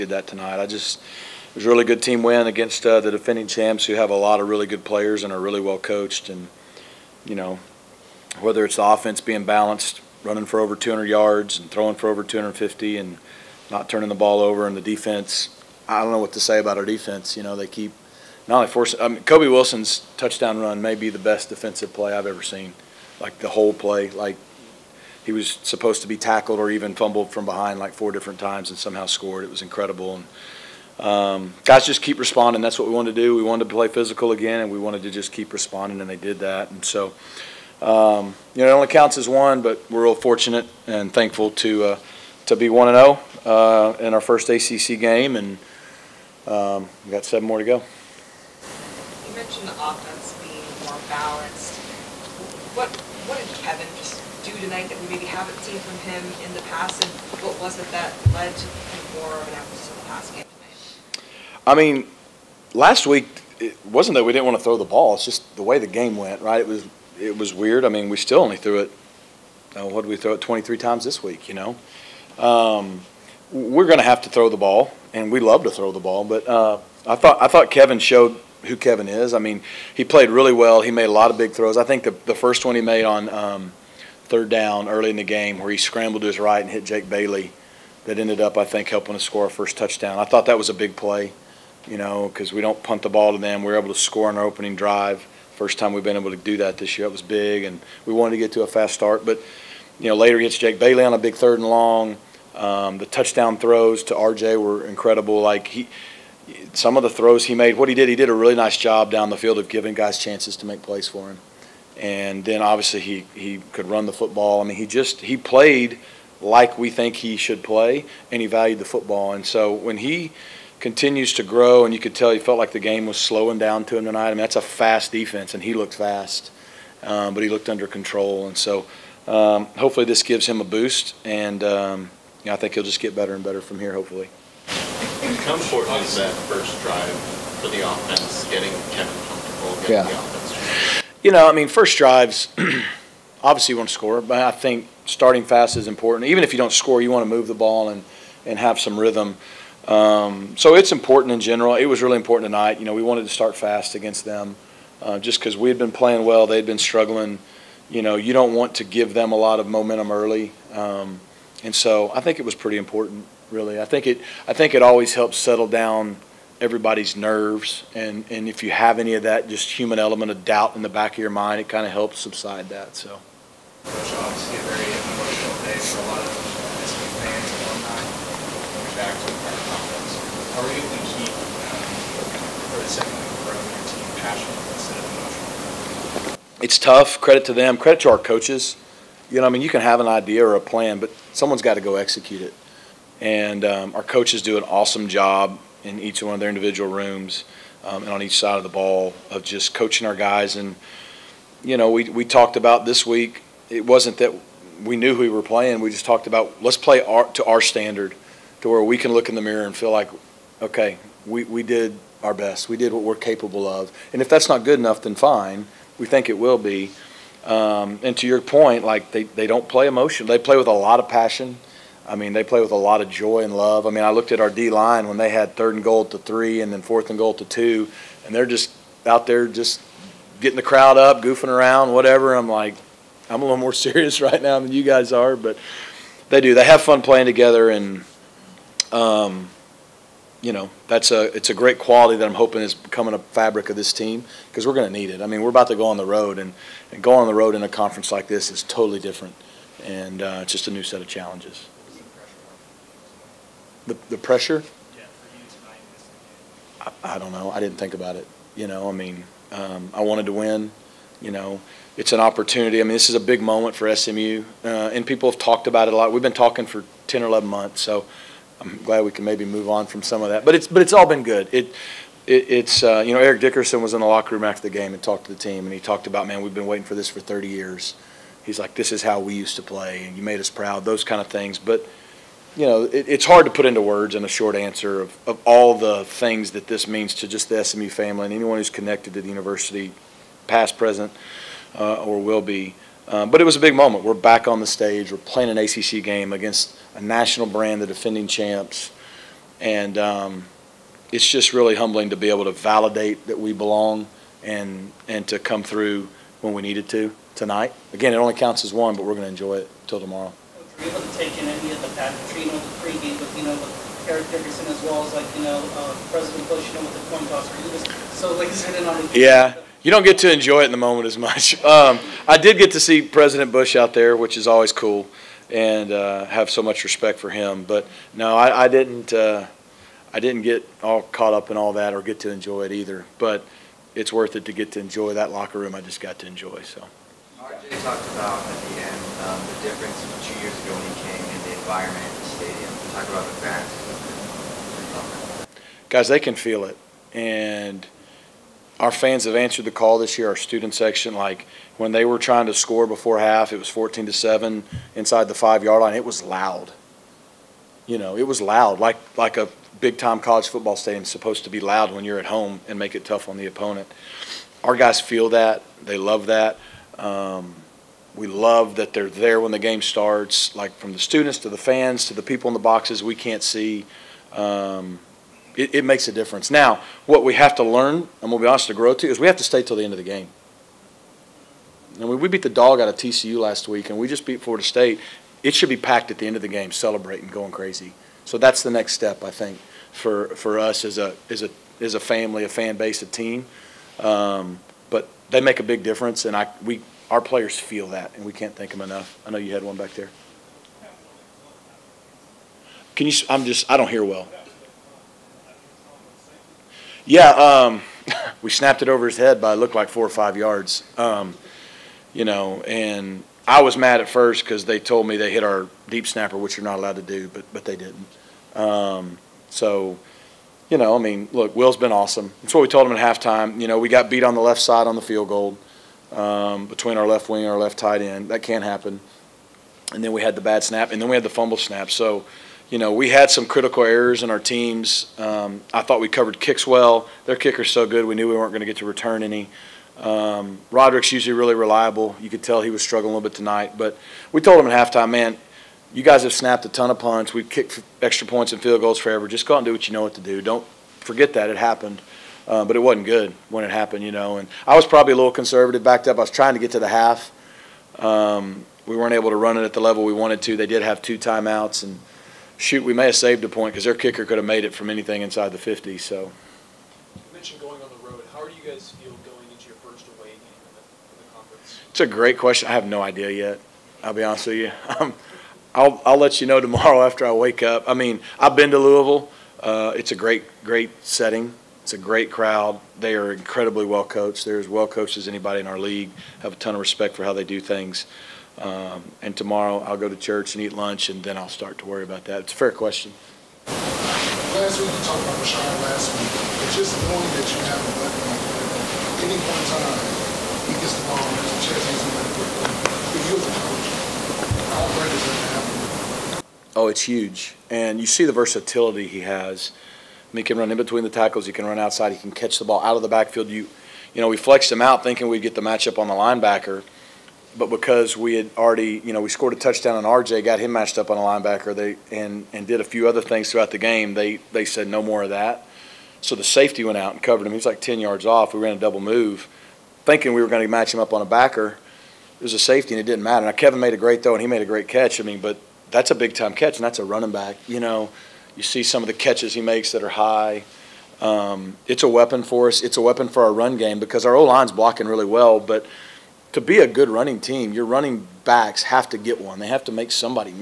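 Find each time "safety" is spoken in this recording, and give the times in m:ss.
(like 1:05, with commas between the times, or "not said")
8:46, 8:52.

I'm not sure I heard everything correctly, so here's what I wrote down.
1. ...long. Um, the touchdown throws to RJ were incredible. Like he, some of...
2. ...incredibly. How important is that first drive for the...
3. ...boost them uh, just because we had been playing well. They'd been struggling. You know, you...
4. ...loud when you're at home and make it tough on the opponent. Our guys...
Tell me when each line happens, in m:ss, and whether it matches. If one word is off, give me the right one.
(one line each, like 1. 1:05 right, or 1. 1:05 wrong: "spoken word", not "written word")
1. 1:41 right
2. 2:13 wrong: "hopefully", not "incredibly"
3. 2:33 wrong: "against", not "boost"
4. 6:01 right.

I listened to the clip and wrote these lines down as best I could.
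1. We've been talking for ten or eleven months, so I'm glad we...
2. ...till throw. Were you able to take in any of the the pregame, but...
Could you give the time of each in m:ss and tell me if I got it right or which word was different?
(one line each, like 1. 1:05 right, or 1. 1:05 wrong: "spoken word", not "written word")
1. 4:26 right
2. 5:09 wrong: "tomorrow", not "throw".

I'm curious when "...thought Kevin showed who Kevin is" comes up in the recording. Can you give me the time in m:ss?
1:17.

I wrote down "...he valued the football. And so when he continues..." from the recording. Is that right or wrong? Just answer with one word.
right.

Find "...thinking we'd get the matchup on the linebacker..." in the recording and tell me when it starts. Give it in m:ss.
8:35.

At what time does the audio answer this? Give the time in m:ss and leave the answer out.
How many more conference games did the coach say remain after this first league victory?
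0:47.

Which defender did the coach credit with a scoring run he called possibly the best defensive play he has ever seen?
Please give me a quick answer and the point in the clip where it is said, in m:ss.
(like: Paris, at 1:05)
Kobe Wilson, at 0:19.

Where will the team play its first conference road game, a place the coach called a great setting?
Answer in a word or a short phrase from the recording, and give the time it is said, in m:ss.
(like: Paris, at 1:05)
Louisville, at 7:58.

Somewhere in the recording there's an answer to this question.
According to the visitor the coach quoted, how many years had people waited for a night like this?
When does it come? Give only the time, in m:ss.
4:37.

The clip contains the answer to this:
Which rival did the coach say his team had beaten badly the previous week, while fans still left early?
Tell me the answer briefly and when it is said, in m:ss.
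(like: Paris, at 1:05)
TCU, at 6:22.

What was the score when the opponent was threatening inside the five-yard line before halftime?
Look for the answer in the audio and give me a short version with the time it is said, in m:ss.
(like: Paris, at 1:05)
14 to 7, at 5:53.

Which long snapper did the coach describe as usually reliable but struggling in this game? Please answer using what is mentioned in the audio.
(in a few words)
Roderick.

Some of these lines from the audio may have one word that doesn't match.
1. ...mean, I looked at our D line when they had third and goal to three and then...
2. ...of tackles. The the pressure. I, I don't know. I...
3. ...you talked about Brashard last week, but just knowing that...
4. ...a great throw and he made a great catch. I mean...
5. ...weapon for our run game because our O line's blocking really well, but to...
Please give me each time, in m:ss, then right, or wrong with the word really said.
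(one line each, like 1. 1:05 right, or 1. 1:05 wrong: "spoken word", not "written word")
1. 3:43 right
2. 4:10 wrong: "challenges", not "tackles"
3. 8:14 right
4. 8:53 right
5. 9:03 right.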